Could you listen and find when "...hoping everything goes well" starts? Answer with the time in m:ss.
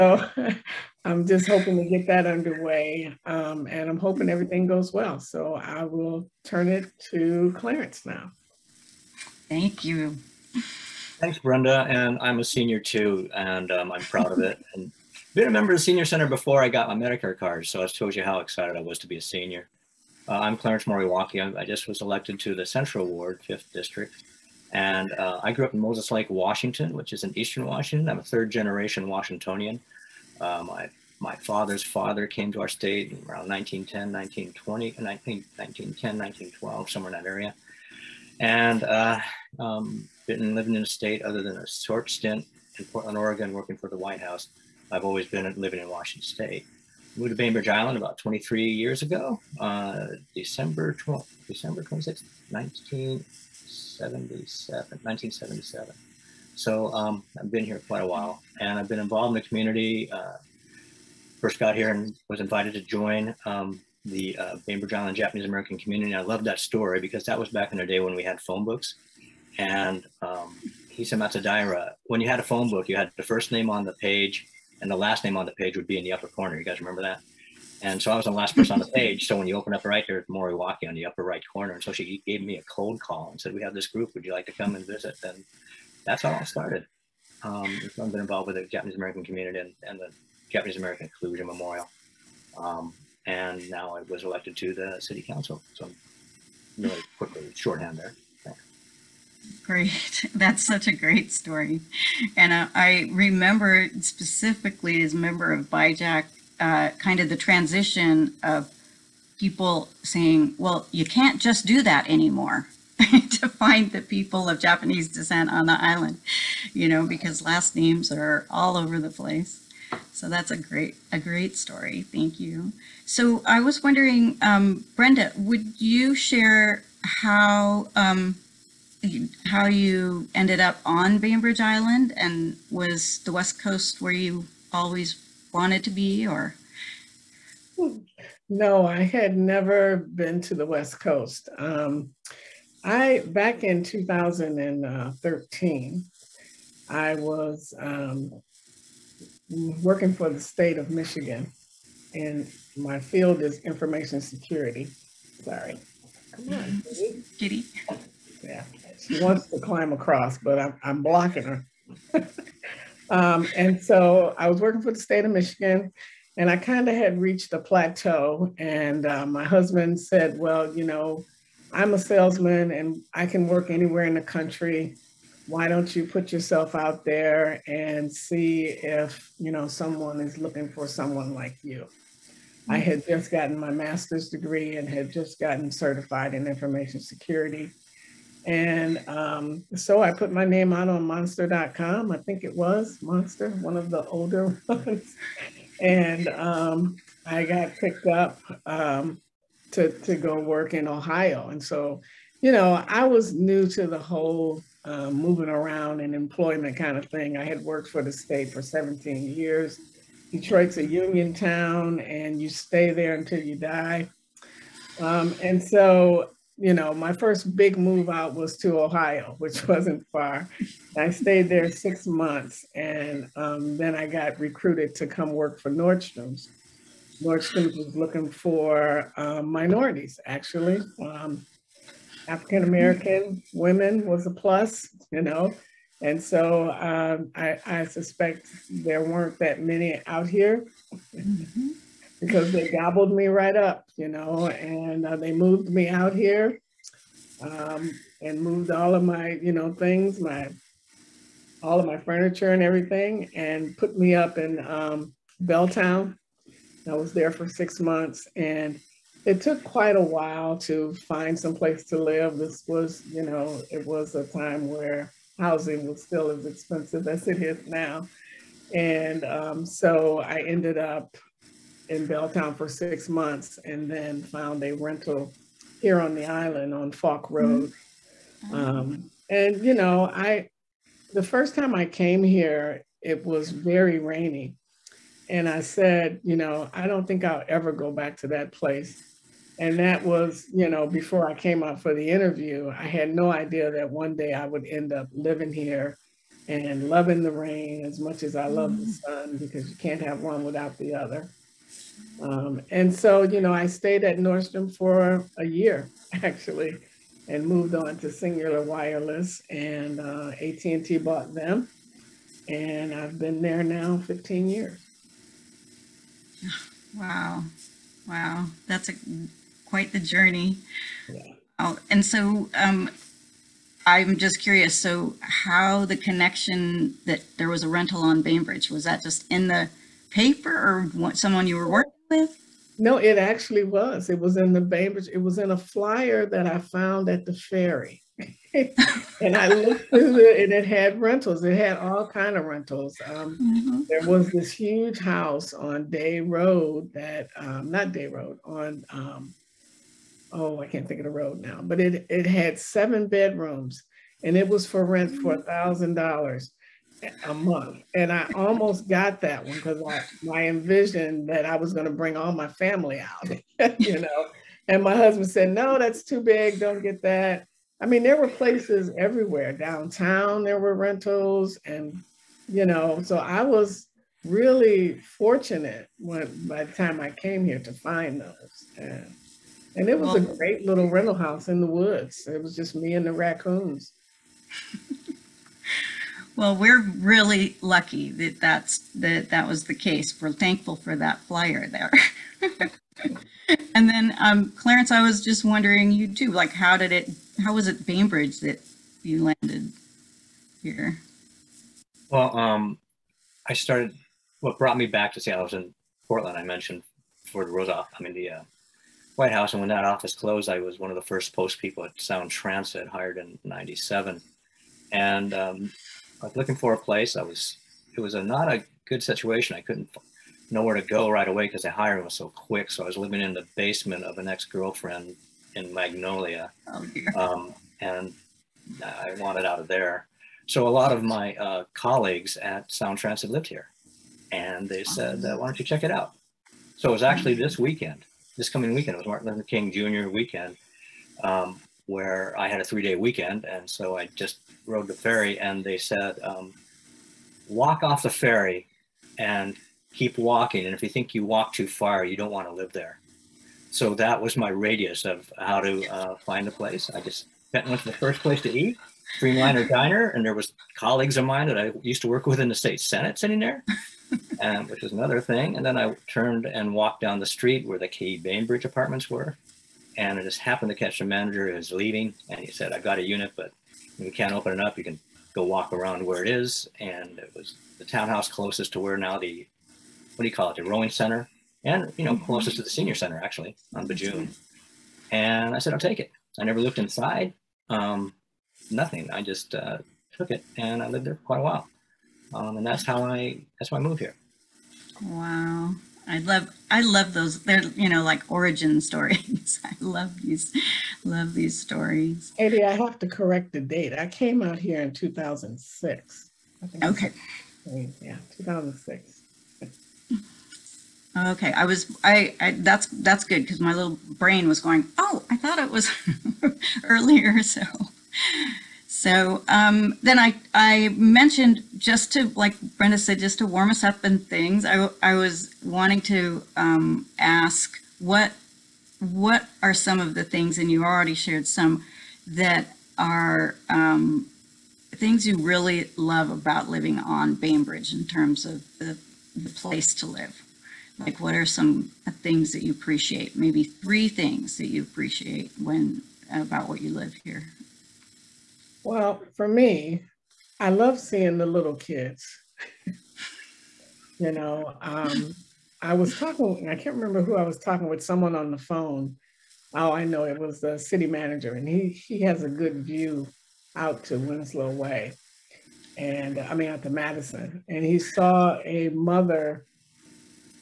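0:03.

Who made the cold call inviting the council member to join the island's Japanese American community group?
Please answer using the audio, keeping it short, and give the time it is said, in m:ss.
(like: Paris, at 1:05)
Hisa Matsudaira, at 1:10.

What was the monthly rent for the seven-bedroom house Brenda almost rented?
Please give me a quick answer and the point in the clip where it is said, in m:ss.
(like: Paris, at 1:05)
$1,000, at 5:55.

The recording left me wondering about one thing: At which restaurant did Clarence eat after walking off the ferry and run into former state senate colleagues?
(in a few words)
Streamliner Diner.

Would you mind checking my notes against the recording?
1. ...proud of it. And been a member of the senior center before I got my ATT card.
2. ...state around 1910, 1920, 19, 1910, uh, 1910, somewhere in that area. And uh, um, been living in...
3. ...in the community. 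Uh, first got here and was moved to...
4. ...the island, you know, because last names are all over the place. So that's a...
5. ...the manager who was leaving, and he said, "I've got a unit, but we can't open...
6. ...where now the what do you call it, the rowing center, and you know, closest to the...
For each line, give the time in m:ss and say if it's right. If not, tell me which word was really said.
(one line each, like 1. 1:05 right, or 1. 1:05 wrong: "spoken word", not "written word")
1. 0:14 wrong: "Medicare", not "ATT"
2. 0:32 wrong: "1912", not "1910"
3. 0:59 wrong: "invited", not "moved"
4. 1:55 right
5. 7:50 right
6. 7:58 right.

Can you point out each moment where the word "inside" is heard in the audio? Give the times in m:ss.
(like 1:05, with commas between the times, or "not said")
8:06.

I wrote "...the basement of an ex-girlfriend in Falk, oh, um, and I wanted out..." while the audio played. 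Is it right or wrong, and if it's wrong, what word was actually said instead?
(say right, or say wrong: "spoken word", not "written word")
wrong: "Magnolia", not "Falk".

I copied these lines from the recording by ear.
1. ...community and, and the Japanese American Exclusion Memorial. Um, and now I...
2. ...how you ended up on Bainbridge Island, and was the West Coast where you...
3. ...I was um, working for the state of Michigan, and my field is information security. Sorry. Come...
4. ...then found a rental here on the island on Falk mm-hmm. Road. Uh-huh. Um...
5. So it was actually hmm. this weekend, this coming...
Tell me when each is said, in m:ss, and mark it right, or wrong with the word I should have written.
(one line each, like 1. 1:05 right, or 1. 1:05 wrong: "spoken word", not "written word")
1. 1:29 right
2. 2:09 right
3. 2:26 right
4. 4:33 right
5. 7:16 right.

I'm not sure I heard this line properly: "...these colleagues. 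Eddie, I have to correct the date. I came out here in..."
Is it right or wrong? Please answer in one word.
wrong.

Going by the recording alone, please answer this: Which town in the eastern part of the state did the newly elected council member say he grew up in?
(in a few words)
Moses Lake.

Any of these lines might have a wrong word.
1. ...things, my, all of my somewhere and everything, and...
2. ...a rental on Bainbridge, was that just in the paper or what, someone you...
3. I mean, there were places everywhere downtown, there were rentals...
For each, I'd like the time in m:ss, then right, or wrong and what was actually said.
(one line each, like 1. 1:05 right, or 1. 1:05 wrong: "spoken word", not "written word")
1. 4:09 wrong: "furniture", not "somewhere"
2. 5:27 right
3. 6:07 right.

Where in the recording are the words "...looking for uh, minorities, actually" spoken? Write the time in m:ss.
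3:47.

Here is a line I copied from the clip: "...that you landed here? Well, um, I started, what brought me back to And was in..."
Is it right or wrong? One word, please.
wrong.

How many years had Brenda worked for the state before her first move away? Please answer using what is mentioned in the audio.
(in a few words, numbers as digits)
17.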